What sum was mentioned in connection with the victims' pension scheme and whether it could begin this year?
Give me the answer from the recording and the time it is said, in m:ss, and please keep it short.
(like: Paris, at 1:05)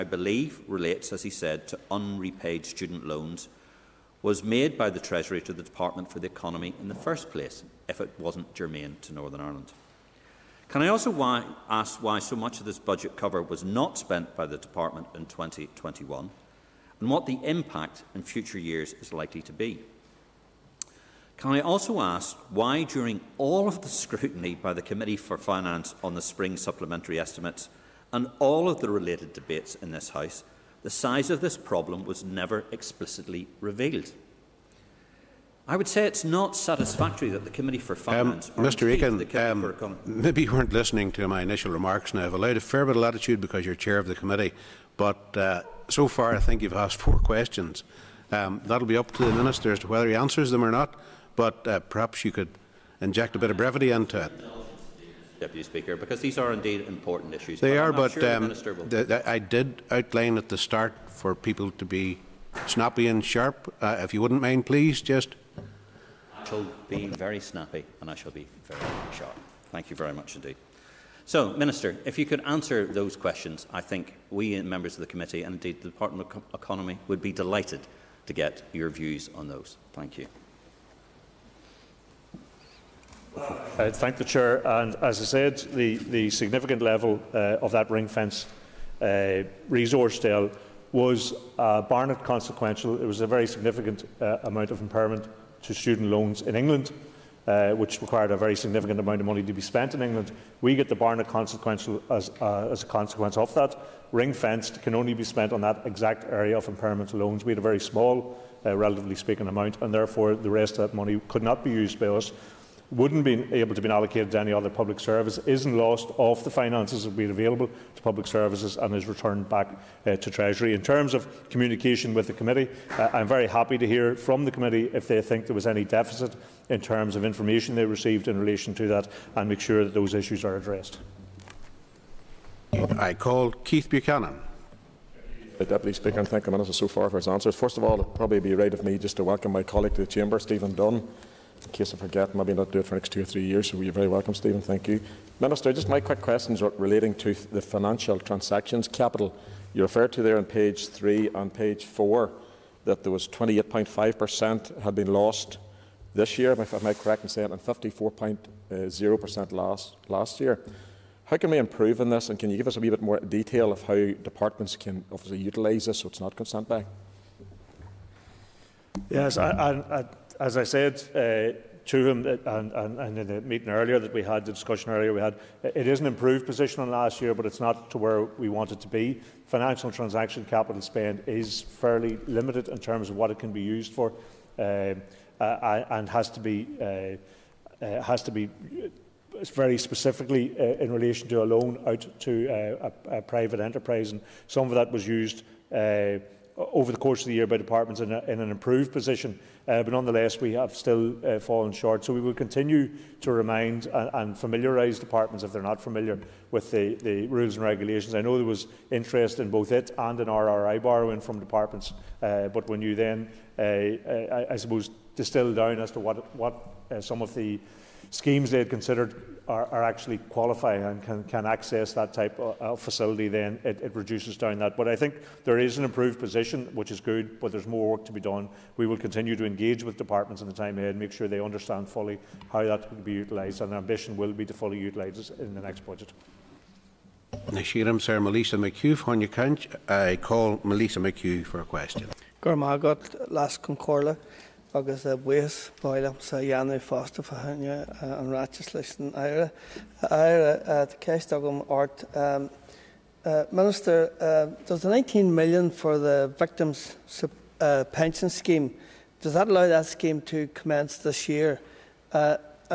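19 million, at 4:14.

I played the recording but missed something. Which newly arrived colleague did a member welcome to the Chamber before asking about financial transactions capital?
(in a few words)
Stephen Dunn.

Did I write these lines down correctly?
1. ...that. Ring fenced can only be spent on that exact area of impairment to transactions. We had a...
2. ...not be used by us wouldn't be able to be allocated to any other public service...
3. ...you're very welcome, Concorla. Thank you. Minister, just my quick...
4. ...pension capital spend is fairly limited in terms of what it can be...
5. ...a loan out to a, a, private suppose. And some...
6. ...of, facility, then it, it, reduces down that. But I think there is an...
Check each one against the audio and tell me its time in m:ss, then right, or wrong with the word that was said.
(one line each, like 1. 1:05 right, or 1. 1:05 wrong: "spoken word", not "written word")
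1. 1:43 wrong: "loans", not "transactions"
2. 1:51 right
3. 2:23 wrong: "Stephen", not "Concorla"
4. 2:59 wrong: "transaction", not "pension"
5. 3:11 wrong: "enterprise", not "suppose"
6. 3:42 right.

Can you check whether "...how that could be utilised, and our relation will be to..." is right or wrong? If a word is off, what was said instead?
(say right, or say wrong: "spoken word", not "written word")
wrong: "ambition", not "relation".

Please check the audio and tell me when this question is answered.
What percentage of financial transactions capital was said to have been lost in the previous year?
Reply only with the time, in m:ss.
2:37.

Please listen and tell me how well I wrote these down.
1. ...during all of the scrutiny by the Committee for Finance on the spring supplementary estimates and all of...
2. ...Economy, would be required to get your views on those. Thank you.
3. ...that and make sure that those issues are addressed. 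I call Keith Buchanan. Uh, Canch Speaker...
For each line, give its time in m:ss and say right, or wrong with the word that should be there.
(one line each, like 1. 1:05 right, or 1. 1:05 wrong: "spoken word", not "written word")
1. 0:22 right
2. 1:16 wrong: "delighted", not "required"
3. 2:08 wrong: "Deputy", not "Canch".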